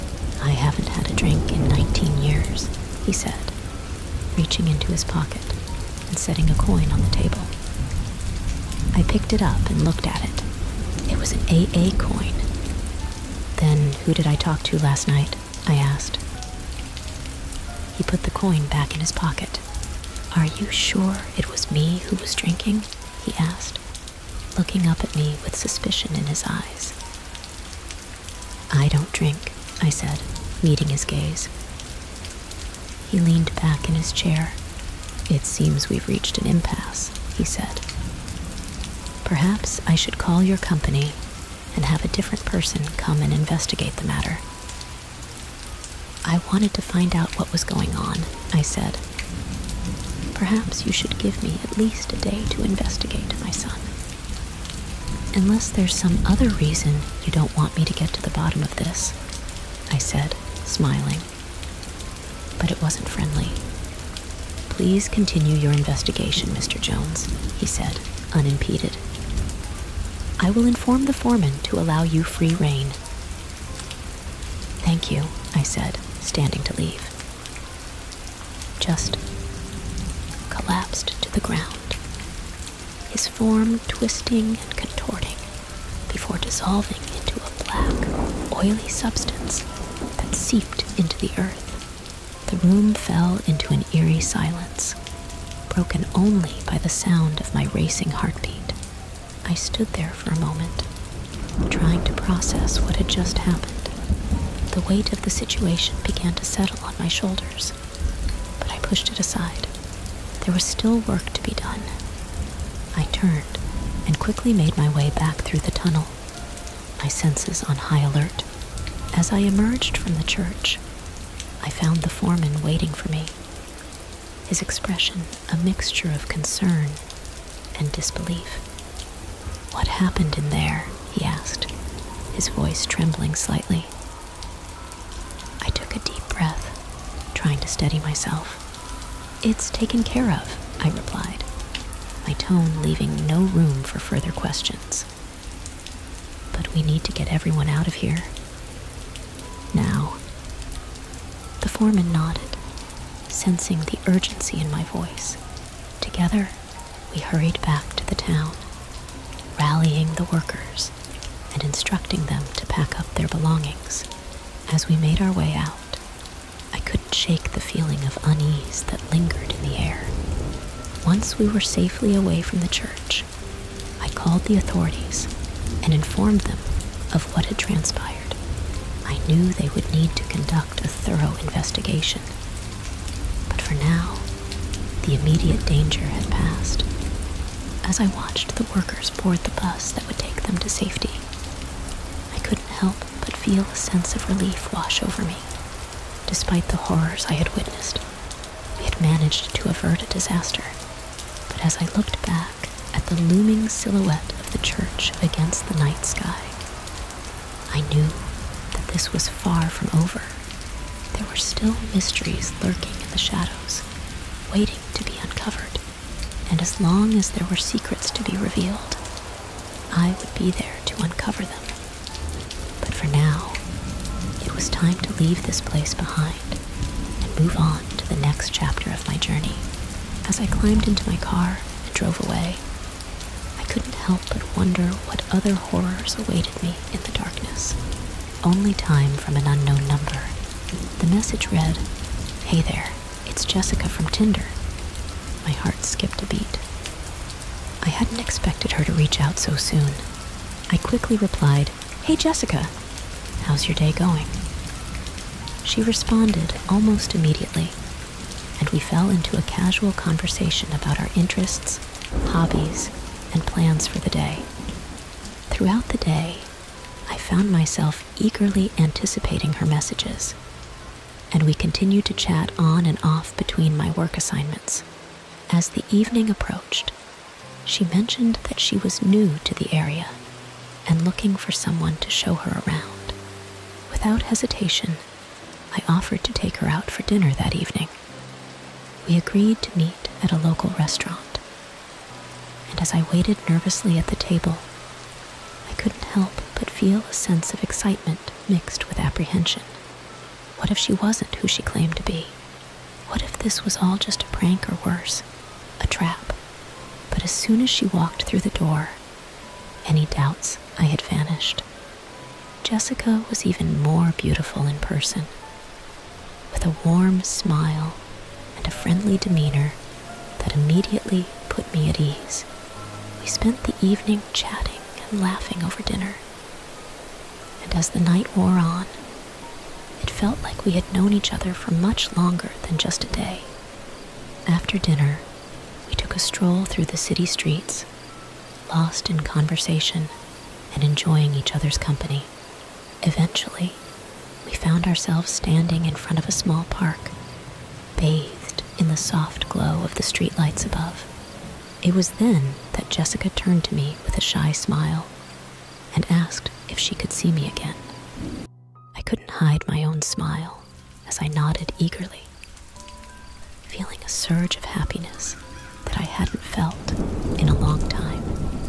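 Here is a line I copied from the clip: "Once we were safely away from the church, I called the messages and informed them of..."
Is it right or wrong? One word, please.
wrong.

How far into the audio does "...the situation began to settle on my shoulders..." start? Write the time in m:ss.
1:45.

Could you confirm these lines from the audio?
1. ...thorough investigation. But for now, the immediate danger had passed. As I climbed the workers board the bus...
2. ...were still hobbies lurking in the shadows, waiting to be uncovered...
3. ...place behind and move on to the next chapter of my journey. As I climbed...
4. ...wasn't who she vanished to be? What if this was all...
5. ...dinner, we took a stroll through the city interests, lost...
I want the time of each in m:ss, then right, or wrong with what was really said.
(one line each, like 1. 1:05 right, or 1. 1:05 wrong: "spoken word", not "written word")
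1. 3:00 wrong: "watched", not "climbed"
2. 3:31 wrong: "mysteries", not "hobbies"
3. 3:45 right
4. 5:00 wrong: "claimed", not "vanished"
5. 5:34 wrong: "streets", not "interests".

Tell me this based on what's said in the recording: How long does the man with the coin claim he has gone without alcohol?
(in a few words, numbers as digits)
19 years.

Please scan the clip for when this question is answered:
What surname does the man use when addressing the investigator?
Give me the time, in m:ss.
1:06.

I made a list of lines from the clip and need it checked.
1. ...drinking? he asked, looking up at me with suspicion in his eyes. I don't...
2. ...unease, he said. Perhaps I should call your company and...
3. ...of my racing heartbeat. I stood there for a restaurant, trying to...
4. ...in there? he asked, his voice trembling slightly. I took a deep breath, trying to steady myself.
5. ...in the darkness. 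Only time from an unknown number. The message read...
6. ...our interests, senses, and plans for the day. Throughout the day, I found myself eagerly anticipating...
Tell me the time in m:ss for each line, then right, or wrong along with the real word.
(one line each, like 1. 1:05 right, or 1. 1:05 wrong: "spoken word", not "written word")
1. 0:22 right
2. 0:36 wrong: "impasse", not "unease"
3. 1:37 wrong: "moment", not "restaurant"
4. 2:10 right
5. 3:56 right
6. 4:20 wrong: "hobbies", not "senses".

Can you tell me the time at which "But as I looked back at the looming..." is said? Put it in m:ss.
3:21.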